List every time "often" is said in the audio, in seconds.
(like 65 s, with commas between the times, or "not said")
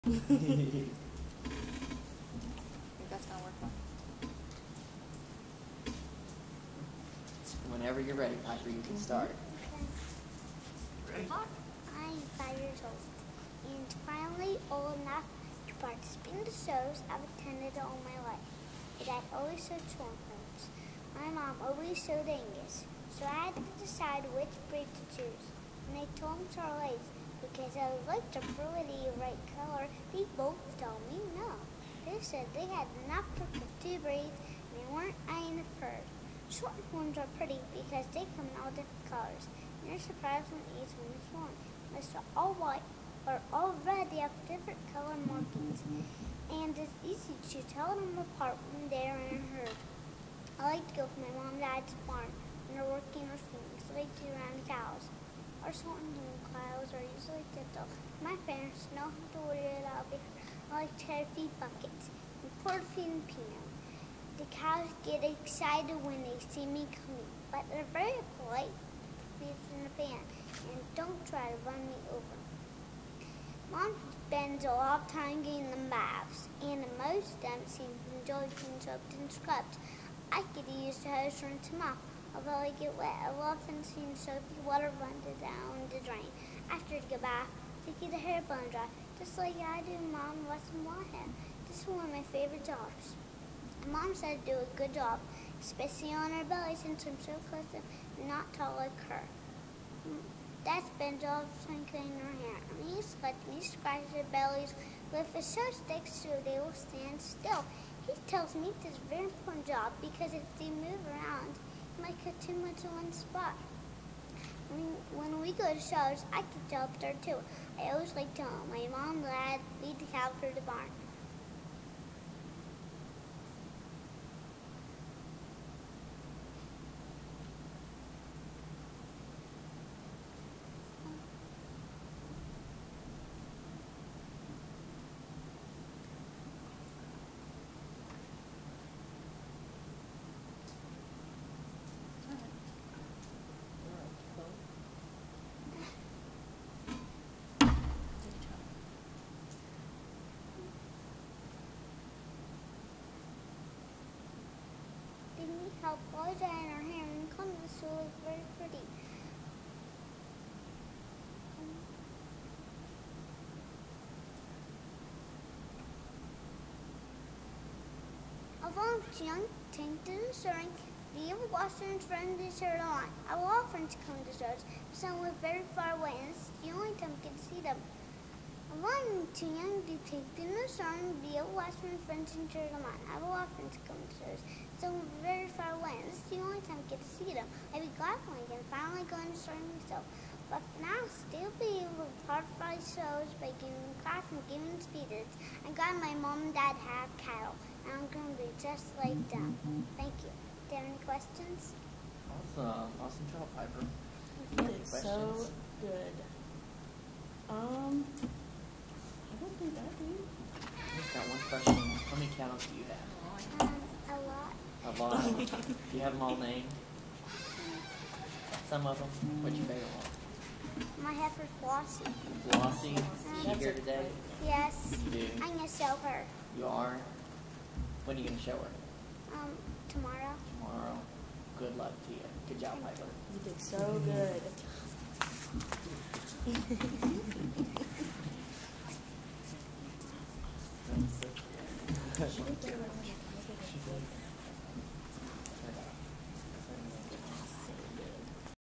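83 s, 183 s.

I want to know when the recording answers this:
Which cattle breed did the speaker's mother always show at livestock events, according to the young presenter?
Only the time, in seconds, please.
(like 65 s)
22 s.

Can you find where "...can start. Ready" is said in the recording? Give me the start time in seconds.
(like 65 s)
8 s.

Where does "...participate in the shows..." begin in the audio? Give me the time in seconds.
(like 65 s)
15 s.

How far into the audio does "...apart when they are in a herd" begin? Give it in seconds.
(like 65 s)
48 s.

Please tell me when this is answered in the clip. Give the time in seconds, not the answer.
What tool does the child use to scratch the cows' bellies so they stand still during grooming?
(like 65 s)
105 s.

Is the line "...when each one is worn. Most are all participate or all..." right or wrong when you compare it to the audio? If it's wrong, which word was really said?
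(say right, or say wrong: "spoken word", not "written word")
wrong: "white", not "participate".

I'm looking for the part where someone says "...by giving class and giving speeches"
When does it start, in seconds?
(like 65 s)
193 s.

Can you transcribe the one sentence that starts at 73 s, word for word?
Mom spends a lot of time getting them baths, and most of them seem to enjoy being soaked and scrubbed.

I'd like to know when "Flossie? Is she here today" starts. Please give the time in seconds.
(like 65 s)
222 s.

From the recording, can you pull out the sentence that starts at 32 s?
They said they had not perfect two braids and they weren't eyeing the fur.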